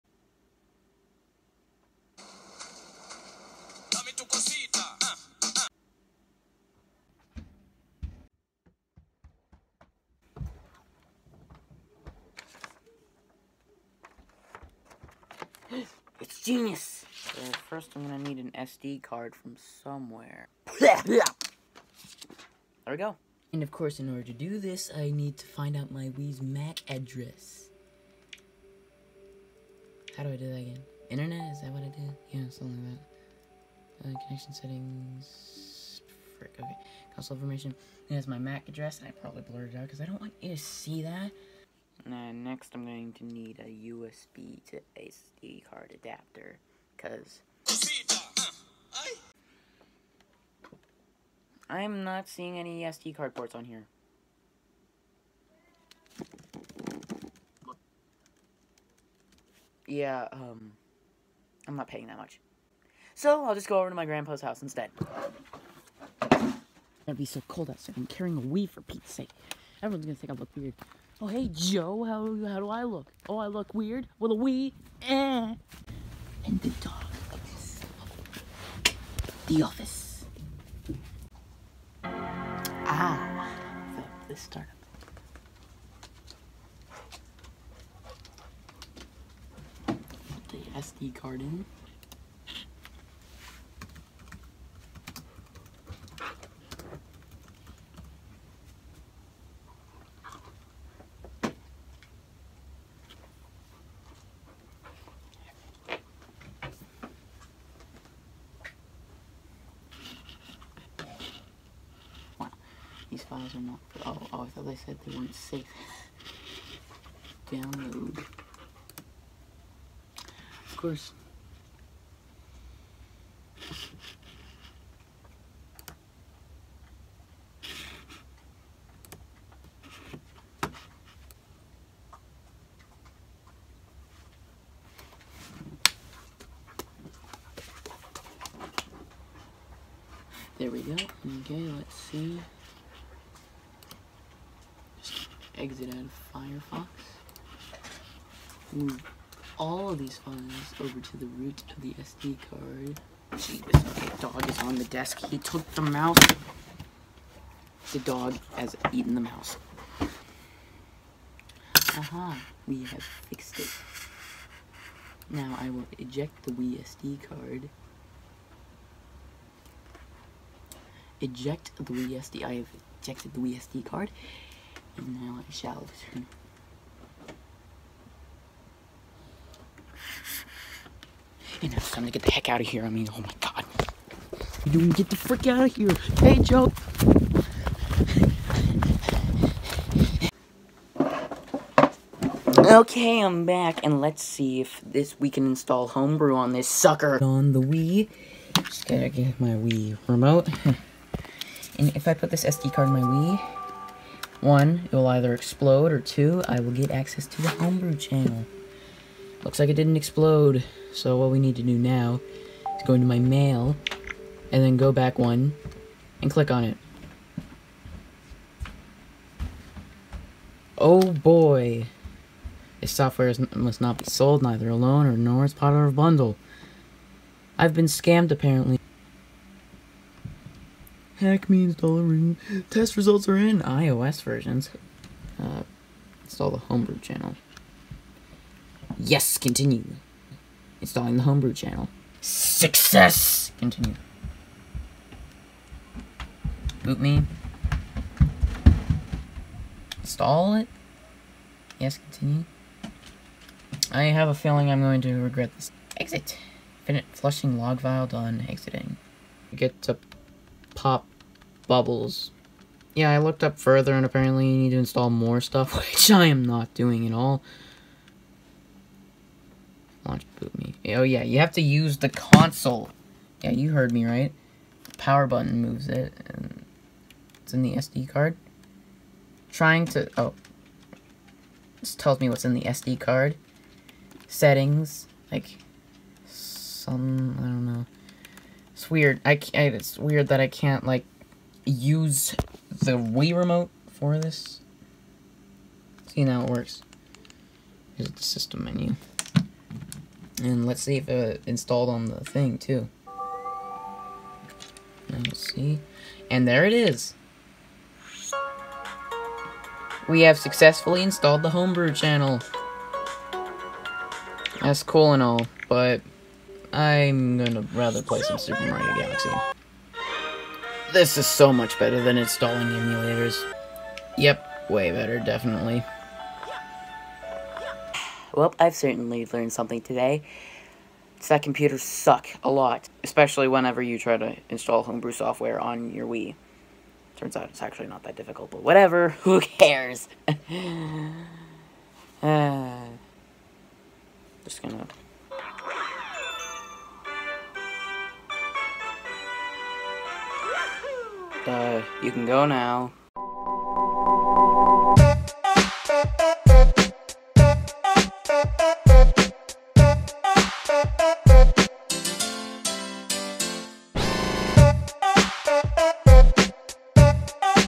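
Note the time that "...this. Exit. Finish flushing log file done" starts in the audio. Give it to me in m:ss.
4:15.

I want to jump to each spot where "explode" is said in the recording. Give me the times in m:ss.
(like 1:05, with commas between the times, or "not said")
3:25, 3:29.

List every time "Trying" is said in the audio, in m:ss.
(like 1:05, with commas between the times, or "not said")
4:39.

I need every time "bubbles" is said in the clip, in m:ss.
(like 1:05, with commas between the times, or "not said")
4:21.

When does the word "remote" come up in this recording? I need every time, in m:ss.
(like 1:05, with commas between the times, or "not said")
3:20, 4:53.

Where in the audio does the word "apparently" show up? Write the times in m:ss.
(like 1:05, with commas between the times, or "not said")
3:48, 4:24.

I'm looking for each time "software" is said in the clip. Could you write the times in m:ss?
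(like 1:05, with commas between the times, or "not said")
3:42, 5:35.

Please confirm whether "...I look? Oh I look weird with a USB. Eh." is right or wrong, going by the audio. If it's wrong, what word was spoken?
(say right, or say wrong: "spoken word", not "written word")
wrong: "Wii", not "USB".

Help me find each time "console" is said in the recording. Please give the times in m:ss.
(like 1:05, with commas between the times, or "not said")
0:37, 4:32.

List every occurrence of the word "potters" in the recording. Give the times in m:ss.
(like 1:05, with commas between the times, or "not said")
not said.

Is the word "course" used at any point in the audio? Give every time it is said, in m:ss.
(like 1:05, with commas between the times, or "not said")
0:23, 2:00.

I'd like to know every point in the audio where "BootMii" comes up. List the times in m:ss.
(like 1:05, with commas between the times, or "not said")
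4:06, 4:30.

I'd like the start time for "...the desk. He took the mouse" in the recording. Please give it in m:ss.
2:34.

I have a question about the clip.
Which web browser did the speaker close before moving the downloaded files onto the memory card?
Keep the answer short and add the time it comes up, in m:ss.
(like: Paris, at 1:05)
Firefox, at 2:26.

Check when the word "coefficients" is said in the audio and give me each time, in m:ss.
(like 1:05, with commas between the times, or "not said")
not said.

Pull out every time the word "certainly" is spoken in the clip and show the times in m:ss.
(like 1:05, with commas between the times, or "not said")
5:28.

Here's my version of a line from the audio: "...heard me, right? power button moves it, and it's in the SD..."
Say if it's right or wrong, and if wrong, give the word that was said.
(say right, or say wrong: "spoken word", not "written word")
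right.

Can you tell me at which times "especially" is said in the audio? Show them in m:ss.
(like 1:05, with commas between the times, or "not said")
5:33.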